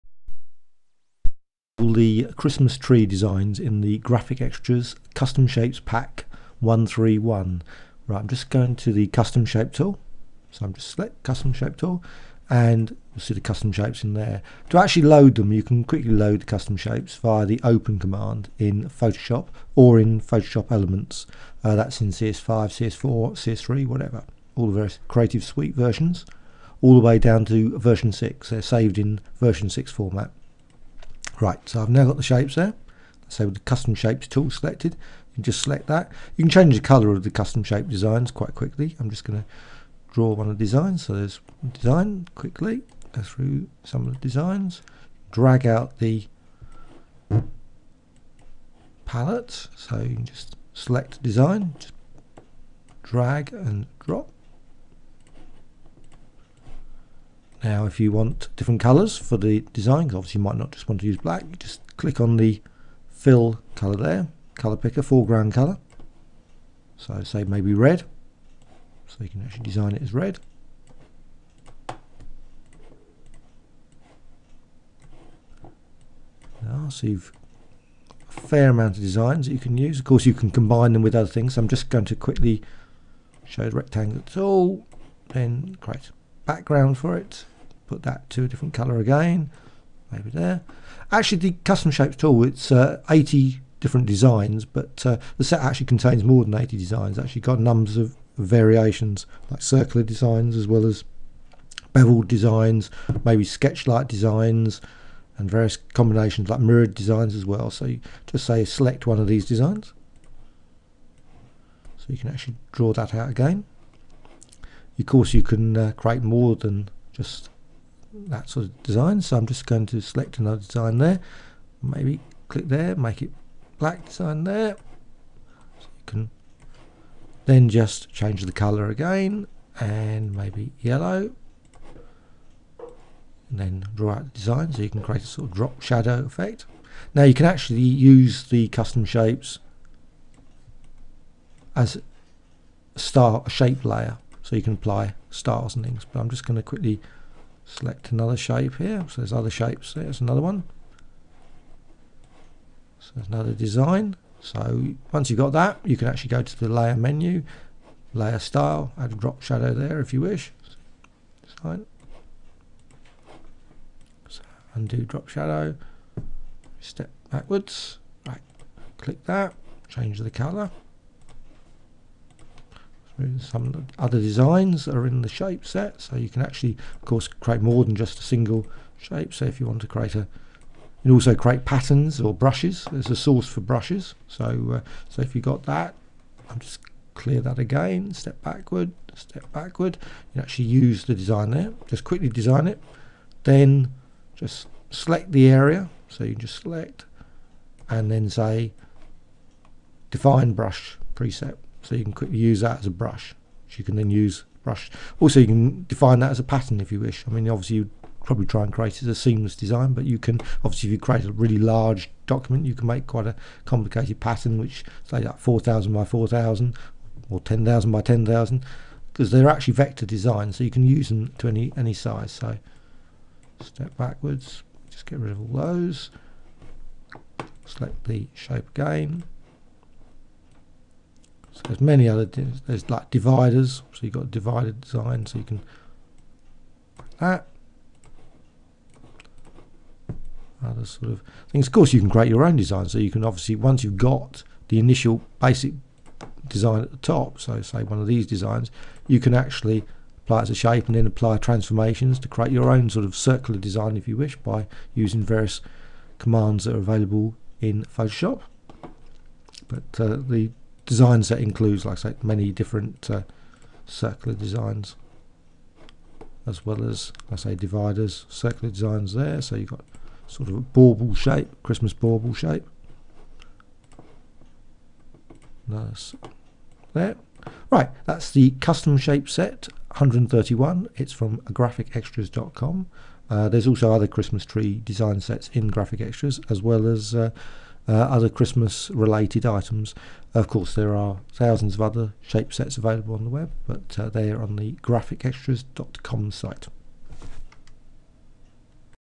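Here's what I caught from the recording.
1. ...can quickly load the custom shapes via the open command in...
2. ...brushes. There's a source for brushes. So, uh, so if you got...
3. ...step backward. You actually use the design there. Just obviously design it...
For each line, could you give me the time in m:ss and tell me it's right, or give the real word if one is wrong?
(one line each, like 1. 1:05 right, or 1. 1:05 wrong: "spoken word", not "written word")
1. 0:15 right
2. 3:02 right
3. 3:09 wrong: "quickly", not "obviously".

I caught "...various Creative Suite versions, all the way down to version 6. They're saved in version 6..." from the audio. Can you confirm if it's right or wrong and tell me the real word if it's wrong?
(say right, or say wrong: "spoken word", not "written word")
right.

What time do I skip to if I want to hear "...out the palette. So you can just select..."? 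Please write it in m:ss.
0:45.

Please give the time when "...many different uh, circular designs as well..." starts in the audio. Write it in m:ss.
4:22.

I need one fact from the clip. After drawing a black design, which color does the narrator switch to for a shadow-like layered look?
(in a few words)
Yellow.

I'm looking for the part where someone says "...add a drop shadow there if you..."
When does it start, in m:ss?
2:38.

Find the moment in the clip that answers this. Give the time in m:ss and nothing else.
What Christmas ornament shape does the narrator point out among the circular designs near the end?
4:31.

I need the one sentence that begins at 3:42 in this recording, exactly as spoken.
So step backwards, just get rid of all those.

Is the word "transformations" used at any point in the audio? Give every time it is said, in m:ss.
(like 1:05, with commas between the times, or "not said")
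4:11.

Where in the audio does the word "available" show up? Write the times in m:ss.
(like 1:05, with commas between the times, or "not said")
4:16, 4:52.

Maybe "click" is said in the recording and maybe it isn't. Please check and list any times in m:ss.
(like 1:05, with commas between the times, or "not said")
1:01, 2:02, 2:48.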